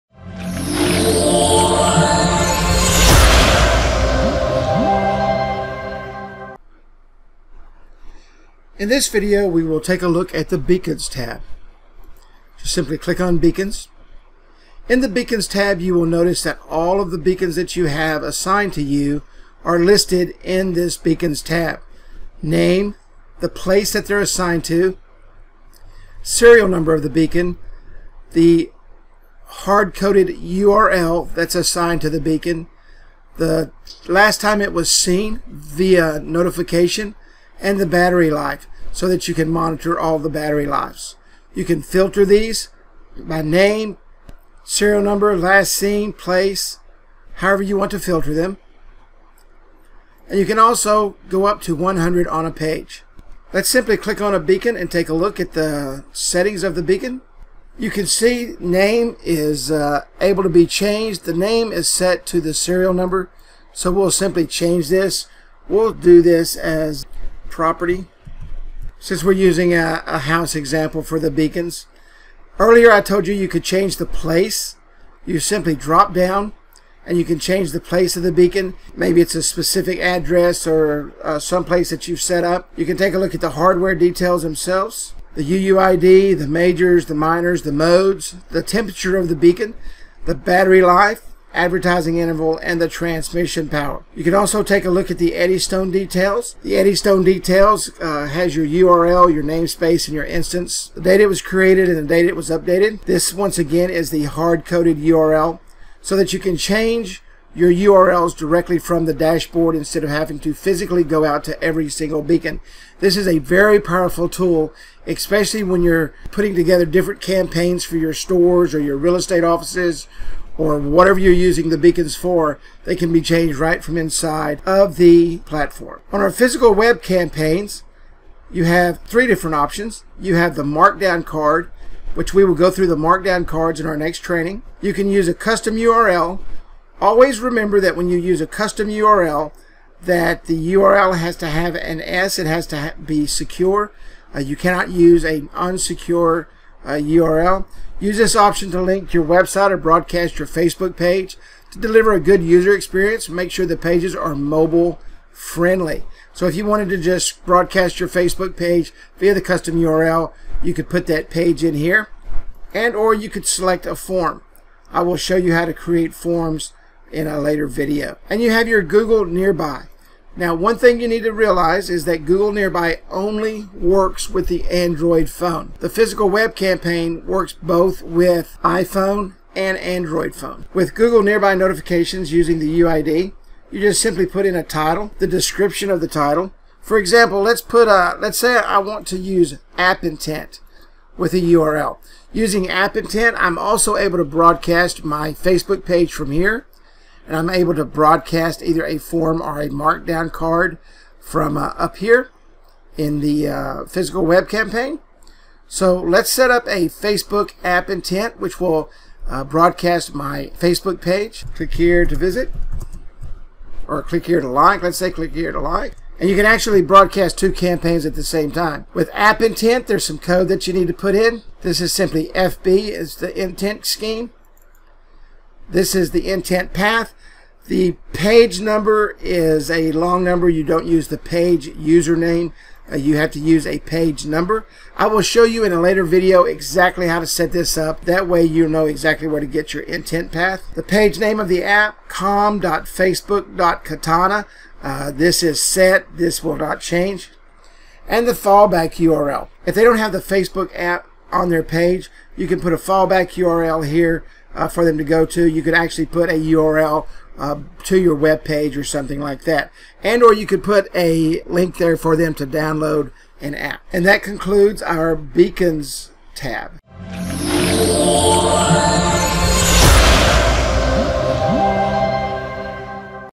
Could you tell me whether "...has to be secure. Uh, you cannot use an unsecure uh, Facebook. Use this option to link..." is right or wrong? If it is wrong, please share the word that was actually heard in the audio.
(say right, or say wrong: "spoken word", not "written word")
wrong: "URL", not "Facebook".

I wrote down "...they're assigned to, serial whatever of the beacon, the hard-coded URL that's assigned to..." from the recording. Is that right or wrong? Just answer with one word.
wrong.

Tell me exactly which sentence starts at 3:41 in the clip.
This is simply FB, is the intent scheme.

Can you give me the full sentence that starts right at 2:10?
You have the markdown card, which we will go through the markdown cards in our next training.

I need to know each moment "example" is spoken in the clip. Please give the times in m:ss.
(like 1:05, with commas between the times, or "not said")
1:10, 3:06.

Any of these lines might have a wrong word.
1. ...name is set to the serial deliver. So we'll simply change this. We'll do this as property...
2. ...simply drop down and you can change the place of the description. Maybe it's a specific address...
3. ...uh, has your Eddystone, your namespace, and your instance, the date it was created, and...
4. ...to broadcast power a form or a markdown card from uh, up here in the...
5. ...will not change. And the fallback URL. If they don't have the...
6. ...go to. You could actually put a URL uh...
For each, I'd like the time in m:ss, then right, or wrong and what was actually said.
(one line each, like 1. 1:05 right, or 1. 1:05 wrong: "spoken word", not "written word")
1. 1:01 wrong: "number", not "deliver"
2. 1:15 wrong: "beacon", not "description"
3. 1:37 wrong: "URL", not "Eddystone"
4. 3:17 wrong: "either", not "power"
5. 4:06 right
6. 4:15 right.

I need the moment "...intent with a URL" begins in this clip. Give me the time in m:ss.
3:10.